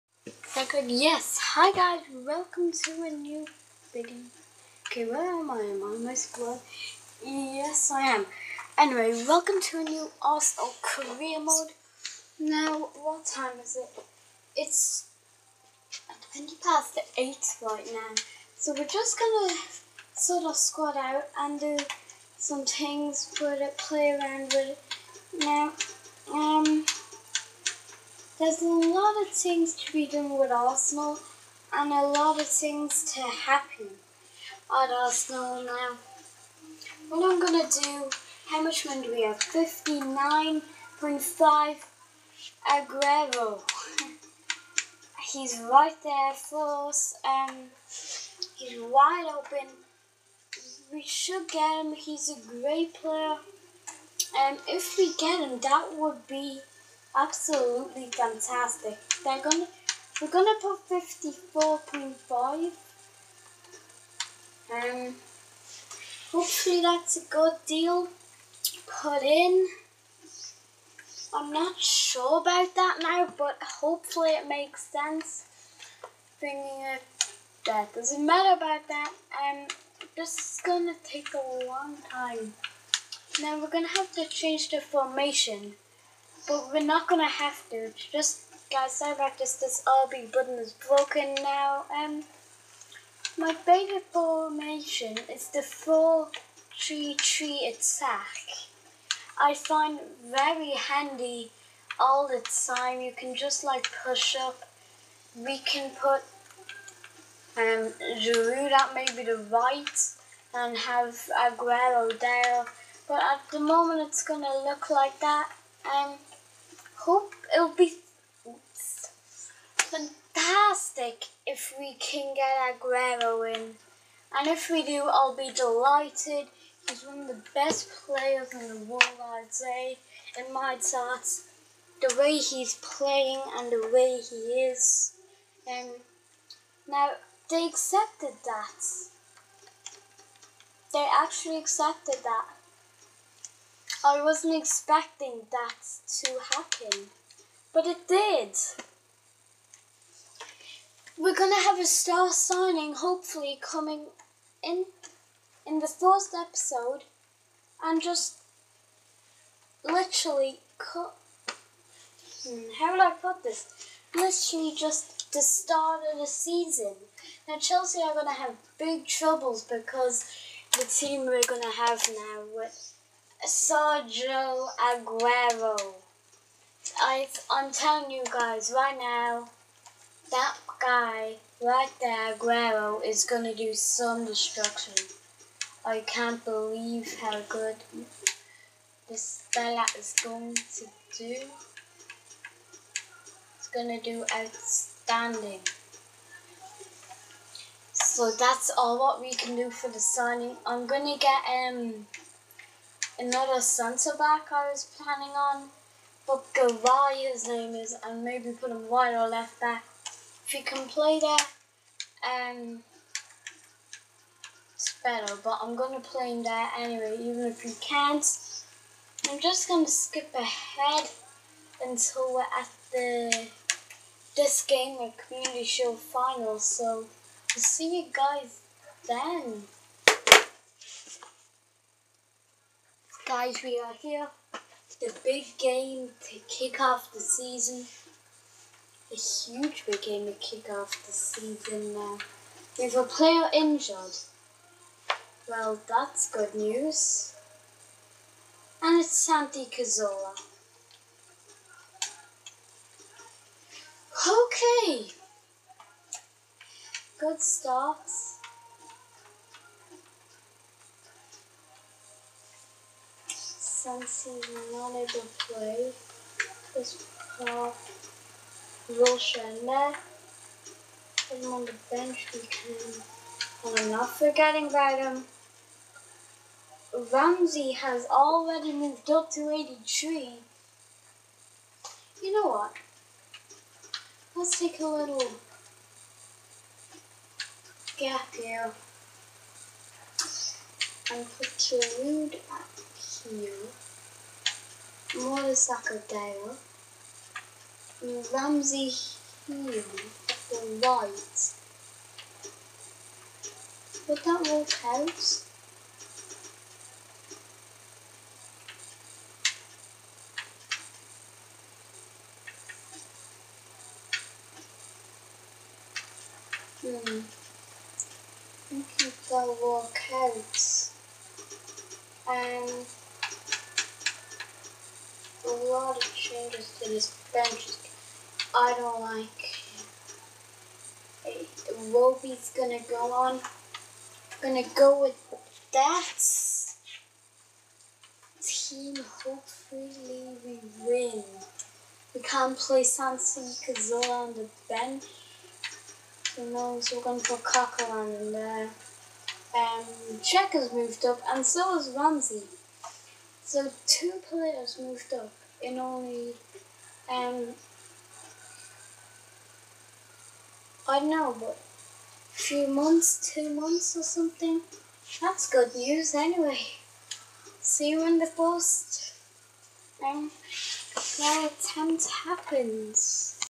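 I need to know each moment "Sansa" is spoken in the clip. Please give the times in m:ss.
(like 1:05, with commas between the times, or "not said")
5:42.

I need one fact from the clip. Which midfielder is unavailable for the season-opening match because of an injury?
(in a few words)
Santi Cazorla.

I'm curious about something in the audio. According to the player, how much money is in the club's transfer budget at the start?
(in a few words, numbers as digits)
59.5.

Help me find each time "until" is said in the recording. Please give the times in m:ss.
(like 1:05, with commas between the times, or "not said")
3:41.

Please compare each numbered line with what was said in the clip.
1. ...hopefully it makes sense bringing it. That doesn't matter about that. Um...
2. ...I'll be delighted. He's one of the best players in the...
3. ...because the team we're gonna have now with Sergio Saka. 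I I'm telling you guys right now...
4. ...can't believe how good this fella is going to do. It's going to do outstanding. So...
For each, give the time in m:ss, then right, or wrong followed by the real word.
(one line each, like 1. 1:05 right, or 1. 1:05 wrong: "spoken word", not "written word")
1. 1:13 right
2. 2:05 right
3. 2:49 wrong: "Aguero", not "Saka"
4. 3:05 right.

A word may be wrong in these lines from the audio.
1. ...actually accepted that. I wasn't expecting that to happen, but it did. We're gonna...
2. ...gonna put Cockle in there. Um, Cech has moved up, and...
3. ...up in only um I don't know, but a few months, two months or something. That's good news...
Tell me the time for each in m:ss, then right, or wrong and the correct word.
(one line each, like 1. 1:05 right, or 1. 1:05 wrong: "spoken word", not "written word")
1. 2:21 right
2. 5:47 right
3. 5:55 right.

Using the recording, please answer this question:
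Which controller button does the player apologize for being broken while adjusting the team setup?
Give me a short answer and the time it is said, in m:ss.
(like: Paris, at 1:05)
RB, at 1:30.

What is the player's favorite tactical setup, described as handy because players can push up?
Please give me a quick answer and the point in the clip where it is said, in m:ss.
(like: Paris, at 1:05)
4-3-3 attack, at 1:35.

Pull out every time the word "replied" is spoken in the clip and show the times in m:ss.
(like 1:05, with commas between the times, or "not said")
not said.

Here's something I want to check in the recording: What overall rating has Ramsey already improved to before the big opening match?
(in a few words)
83.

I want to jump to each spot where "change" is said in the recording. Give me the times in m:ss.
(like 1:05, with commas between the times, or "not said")
1:24, 5:26.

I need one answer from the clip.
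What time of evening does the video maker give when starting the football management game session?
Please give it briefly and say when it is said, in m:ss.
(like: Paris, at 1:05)
20 past 8, at 0:16.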